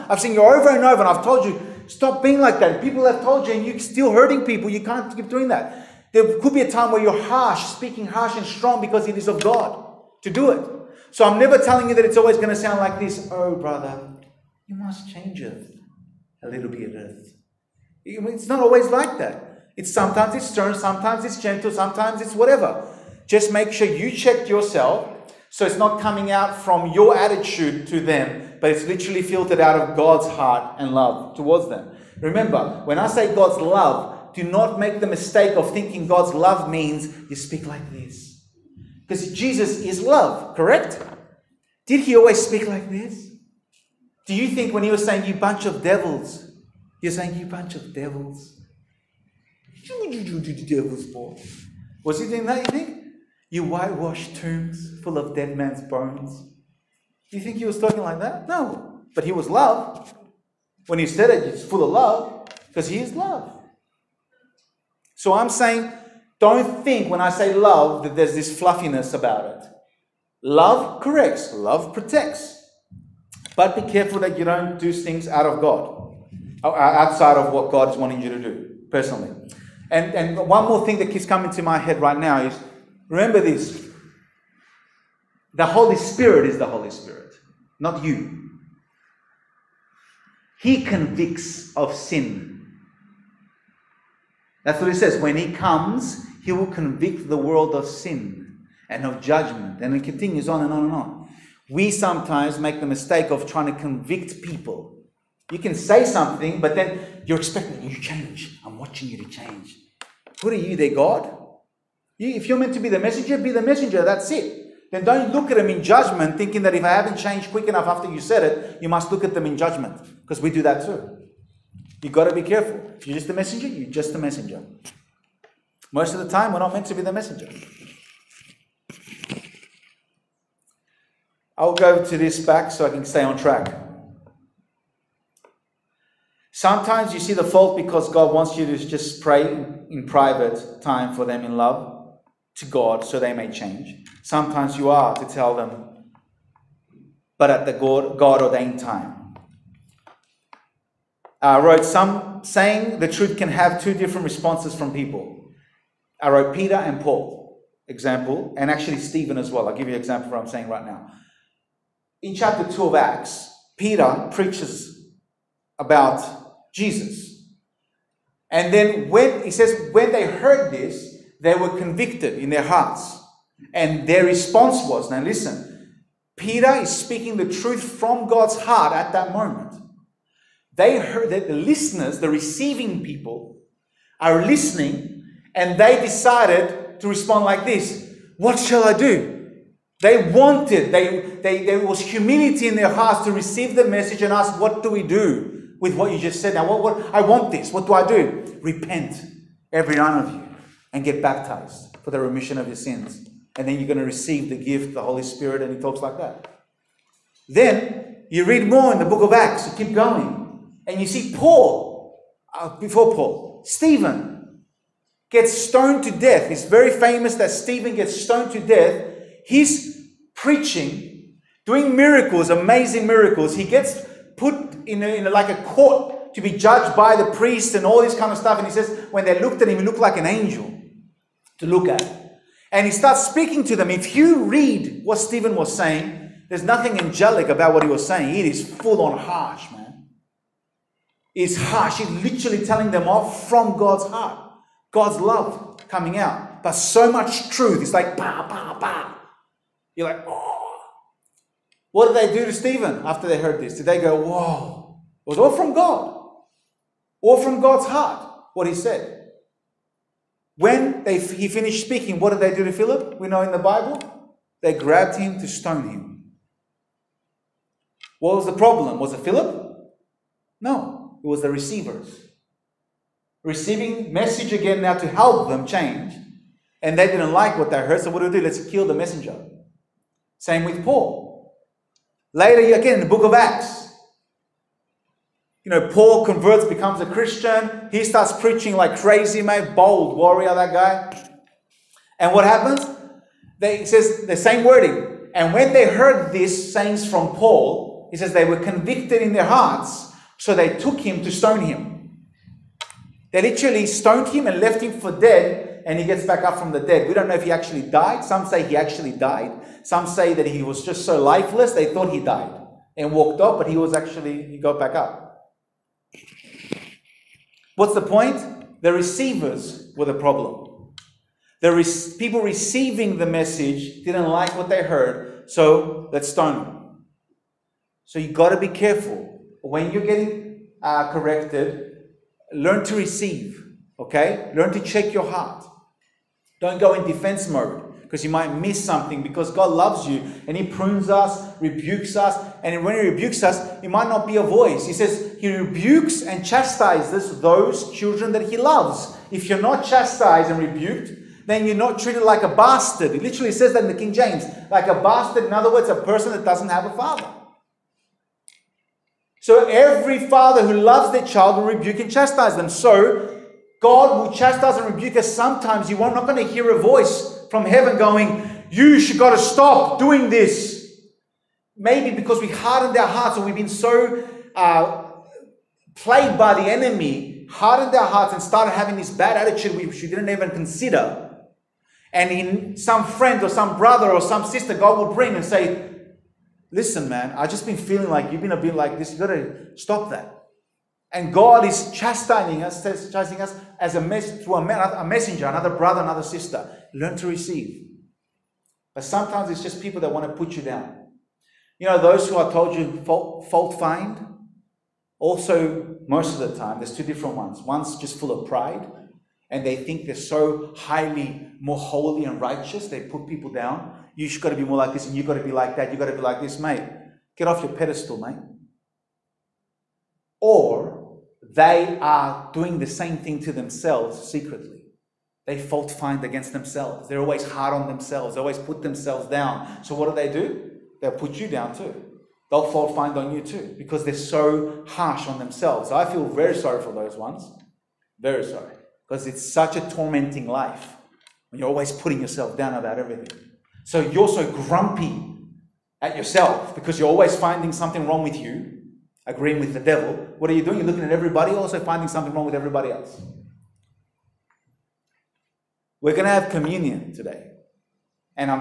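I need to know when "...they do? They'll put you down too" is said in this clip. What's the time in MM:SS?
07:10.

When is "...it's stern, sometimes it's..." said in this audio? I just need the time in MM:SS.
00:20.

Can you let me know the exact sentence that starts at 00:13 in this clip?
Oh, brother, you must change it a little bit.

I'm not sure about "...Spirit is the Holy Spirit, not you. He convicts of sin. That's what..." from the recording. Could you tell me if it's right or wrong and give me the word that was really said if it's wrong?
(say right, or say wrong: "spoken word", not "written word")
right.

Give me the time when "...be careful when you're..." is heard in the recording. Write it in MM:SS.
05:28.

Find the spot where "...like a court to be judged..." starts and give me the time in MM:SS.
03:45.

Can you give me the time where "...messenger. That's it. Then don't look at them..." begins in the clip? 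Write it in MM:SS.
01:53.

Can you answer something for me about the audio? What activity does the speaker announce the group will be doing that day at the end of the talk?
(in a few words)
communion.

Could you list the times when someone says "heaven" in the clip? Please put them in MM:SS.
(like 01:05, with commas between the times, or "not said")
06:07.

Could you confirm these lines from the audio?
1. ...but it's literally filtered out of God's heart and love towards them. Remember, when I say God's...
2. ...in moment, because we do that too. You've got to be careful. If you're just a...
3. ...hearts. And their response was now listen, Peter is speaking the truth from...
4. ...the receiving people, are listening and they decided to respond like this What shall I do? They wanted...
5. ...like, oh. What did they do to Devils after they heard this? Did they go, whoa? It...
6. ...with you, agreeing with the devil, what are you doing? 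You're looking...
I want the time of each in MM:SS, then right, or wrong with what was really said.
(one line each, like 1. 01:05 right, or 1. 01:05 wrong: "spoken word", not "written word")
1. 00:28 right
2. 01:59 wrong: "judgment", not "moment"
3. 02:52 right
4. 03:02 right
5. 04:10 wrong: "Stephen", not "Devils"
6. 07:28 right.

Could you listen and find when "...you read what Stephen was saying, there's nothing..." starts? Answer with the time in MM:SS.
03:54.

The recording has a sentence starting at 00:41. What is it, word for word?
Did he always speak like this?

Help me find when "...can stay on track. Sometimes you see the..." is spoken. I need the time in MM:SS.
02:12.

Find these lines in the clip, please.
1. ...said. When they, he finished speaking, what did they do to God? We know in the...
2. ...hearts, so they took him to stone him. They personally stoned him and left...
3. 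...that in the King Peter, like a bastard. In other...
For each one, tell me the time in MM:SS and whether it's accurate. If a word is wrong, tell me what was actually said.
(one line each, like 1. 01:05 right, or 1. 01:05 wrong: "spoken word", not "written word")
1. 04:18 wrong: "Philip", not "God"
2. 04:59 wrong: "literally", not "personally"
3. 05:53 wrong: "James", not "Peter".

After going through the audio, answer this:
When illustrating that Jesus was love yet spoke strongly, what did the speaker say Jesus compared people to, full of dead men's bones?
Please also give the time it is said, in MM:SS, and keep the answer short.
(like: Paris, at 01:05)
whitewash tombs, at 00:53.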